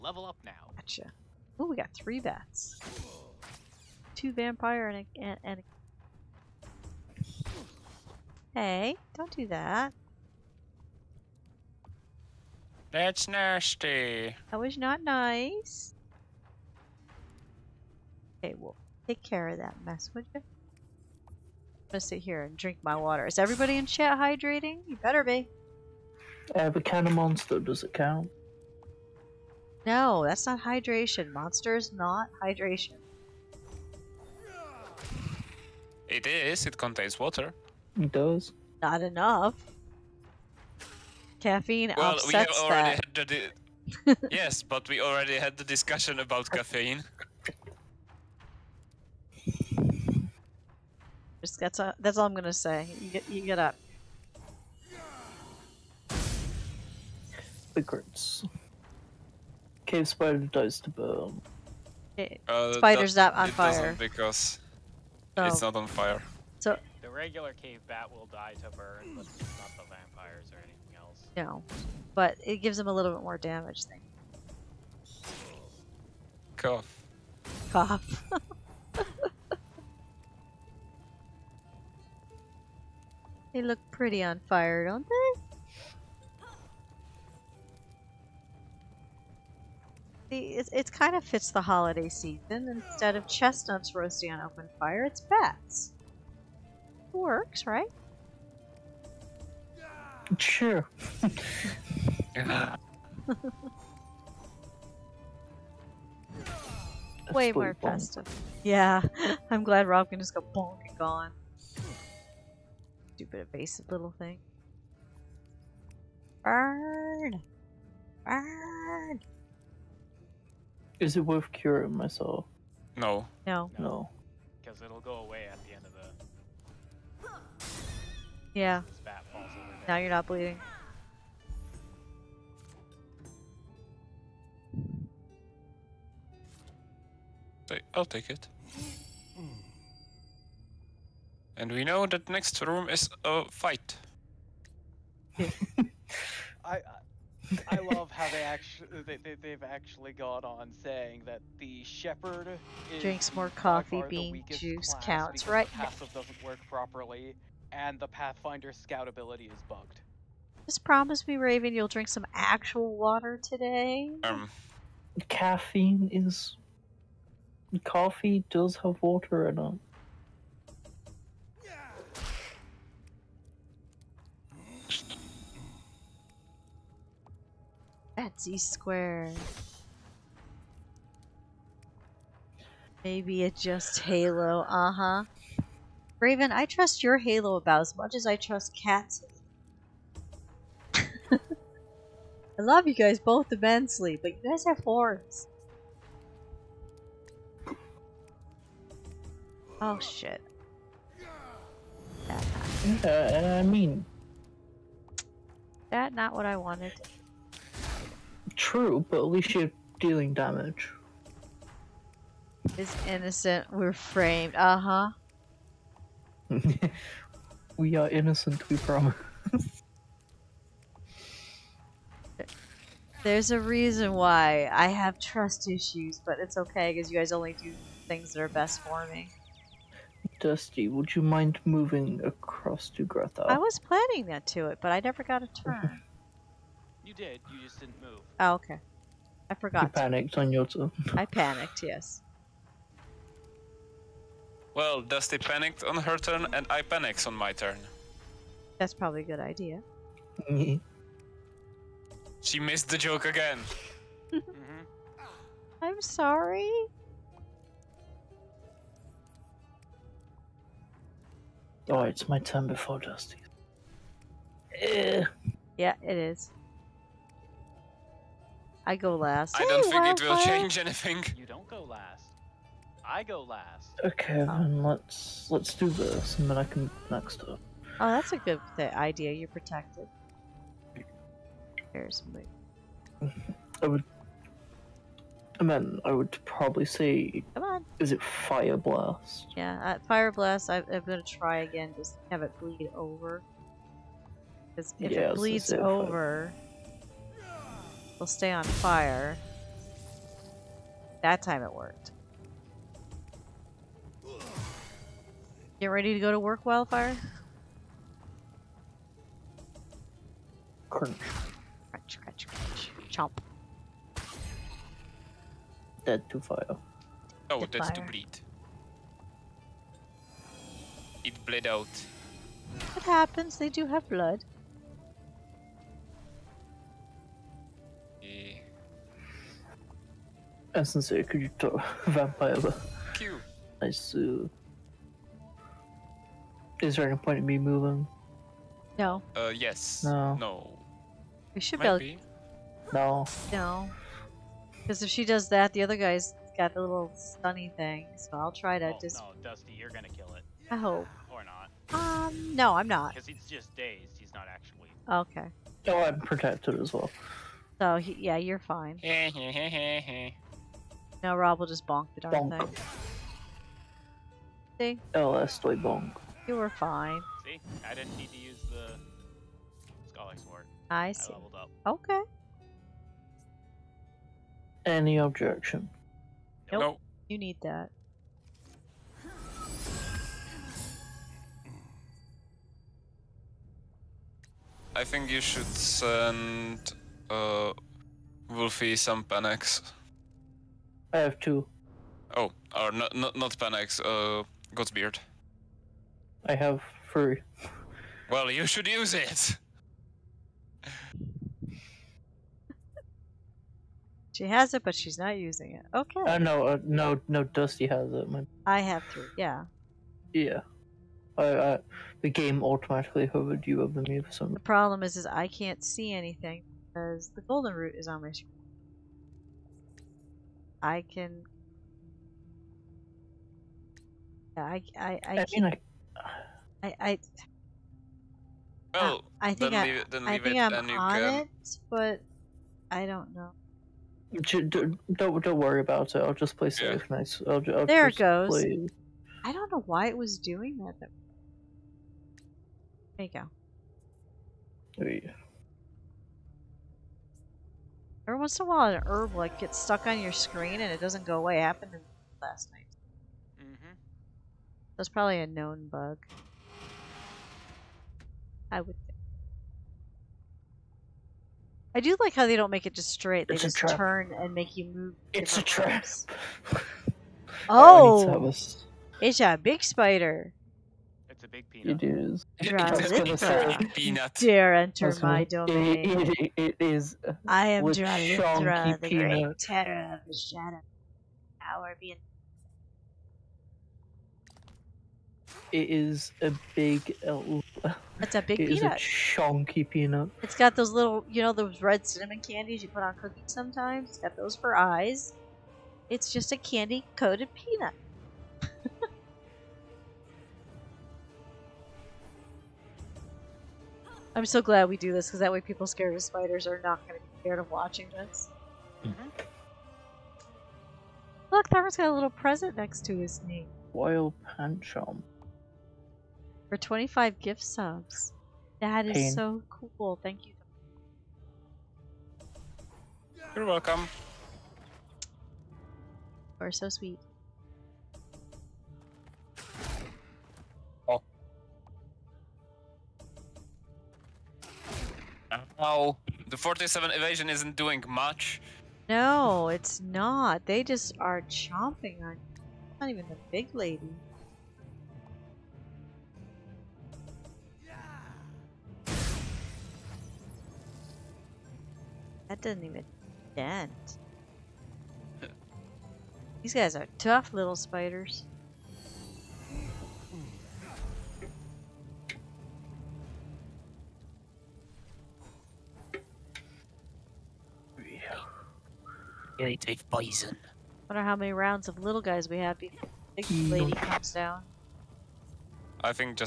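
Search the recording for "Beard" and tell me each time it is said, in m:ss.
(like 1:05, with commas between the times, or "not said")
6:34.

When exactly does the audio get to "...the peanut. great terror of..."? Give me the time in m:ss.
7:58.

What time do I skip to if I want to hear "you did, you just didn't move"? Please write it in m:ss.
3:57.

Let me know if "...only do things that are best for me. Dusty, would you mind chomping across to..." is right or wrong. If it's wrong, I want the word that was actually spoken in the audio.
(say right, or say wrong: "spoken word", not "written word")
wrong: "moving", not "chomping".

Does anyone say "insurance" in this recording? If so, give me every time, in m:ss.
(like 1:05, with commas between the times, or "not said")
not said.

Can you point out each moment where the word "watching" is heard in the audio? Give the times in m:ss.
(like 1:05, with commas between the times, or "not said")
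8:27.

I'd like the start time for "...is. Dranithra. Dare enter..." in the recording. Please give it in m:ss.
7:52.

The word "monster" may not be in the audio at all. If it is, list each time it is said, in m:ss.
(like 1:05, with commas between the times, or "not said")
0:27, 0:31.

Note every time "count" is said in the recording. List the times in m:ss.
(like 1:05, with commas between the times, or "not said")
0:27, 2:35.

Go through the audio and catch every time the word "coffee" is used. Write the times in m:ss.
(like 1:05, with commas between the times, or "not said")
2:33, 2:47.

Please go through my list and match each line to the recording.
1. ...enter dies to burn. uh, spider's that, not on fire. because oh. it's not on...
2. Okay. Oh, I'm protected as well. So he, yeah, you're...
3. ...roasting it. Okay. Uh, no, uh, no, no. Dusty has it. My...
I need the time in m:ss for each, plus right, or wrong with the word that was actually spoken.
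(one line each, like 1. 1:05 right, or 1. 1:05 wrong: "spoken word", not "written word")
1. 1:00 wrong: "spider", not "enter"
2. 5:55 right
3. 6:45 wrong: "using", not "roasting".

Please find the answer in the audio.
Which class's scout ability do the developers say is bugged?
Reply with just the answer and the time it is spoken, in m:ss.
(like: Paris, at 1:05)
Pathfinder, at 2:38.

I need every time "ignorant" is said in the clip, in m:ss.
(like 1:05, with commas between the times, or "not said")
not said.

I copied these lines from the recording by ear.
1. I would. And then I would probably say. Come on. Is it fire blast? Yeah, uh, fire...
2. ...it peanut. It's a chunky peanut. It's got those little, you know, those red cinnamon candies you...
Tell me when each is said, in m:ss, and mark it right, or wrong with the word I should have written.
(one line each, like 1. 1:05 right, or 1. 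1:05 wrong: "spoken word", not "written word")
1. 4:43 right
2. 8:08 right.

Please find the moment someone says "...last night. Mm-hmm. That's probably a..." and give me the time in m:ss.
7:32.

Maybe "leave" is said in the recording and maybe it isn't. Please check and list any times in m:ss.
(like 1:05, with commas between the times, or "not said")
7:09.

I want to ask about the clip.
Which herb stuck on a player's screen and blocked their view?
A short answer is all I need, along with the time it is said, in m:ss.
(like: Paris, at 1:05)
golden root, at 6:57.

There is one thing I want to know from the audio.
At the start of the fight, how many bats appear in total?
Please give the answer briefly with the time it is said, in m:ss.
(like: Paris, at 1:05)
3, at 0:01.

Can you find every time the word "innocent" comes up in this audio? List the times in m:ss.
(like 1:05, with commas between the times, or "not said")
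3:33, 3:38.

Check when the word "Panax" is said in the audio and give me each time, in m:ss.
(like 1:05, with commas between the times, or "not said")
6:29, 6:33.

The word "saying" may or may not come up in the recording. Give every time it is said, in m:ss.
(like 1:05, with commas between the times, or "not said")
2:30.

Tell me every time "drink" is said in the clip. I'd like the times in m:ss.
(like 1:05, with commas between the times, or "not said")
0:22, 2:32, 2:41.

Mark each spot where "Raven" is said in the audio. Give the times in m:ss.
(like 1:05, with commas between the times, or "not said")
2:41, 3:06.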